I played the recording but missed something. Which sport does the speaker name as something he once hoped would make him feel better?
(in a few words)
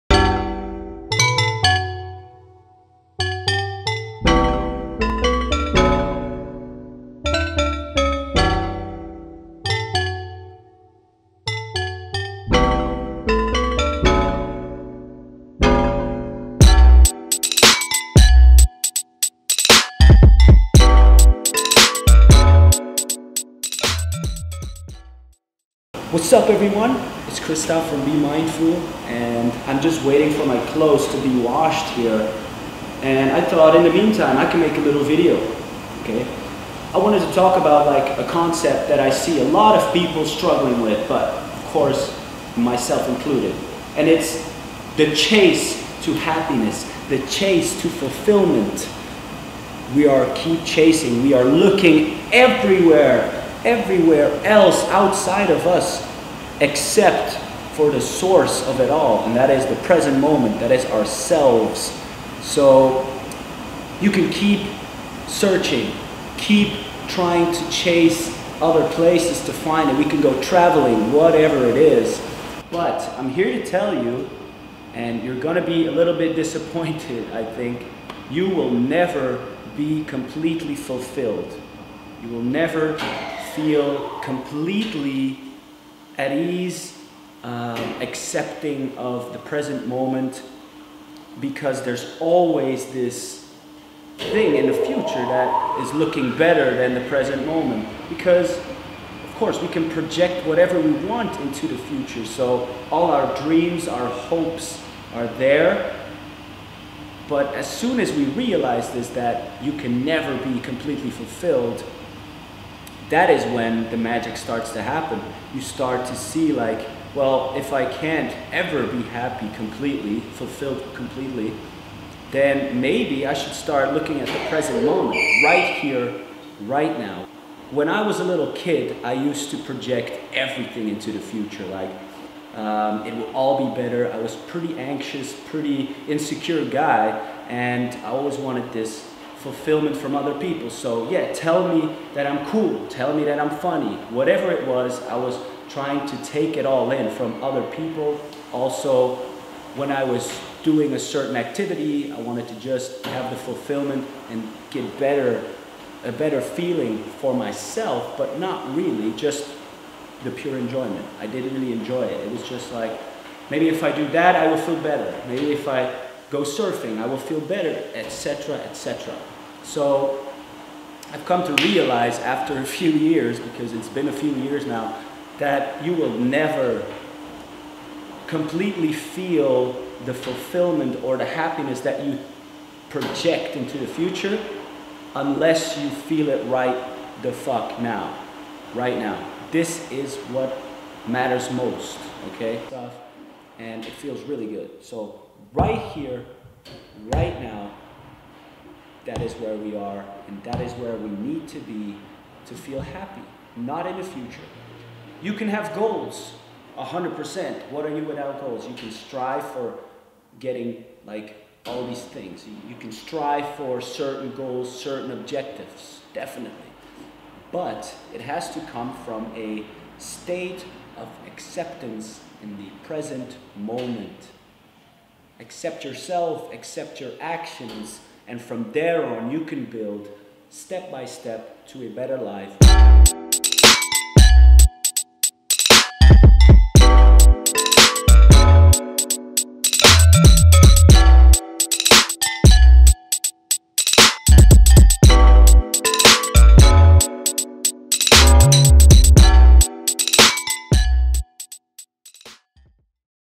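Surfing.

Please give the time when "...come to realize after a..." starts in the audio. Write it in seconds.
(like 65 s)
171 s.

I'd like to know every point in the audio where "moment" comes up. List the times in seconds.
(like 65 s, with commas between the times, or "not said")
60 s, 89 s, 97 s, 124 s, 223 s.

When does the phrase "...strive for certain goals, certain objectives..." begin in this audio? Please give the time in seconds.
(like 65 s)
212 s.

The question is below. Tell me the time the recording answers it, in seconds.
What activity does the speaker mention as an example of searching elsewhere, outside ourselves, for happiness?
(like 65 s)
70 s.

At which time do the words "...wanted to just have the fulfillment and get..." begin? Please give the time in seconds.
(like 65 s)
152 s.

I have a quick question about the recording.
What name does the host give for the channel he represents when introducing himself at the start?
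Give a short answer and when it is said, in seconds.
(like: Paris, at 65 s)
Be Mindful, at 28 s.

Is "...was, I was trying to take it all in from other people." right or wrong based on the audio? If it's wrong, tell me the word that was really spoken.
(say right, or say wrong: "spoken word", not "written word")
right.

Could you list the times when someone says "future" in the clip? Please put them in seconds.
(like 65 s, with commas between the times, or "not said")
94 s, 101 s, 131 s, 183 s, 204 s.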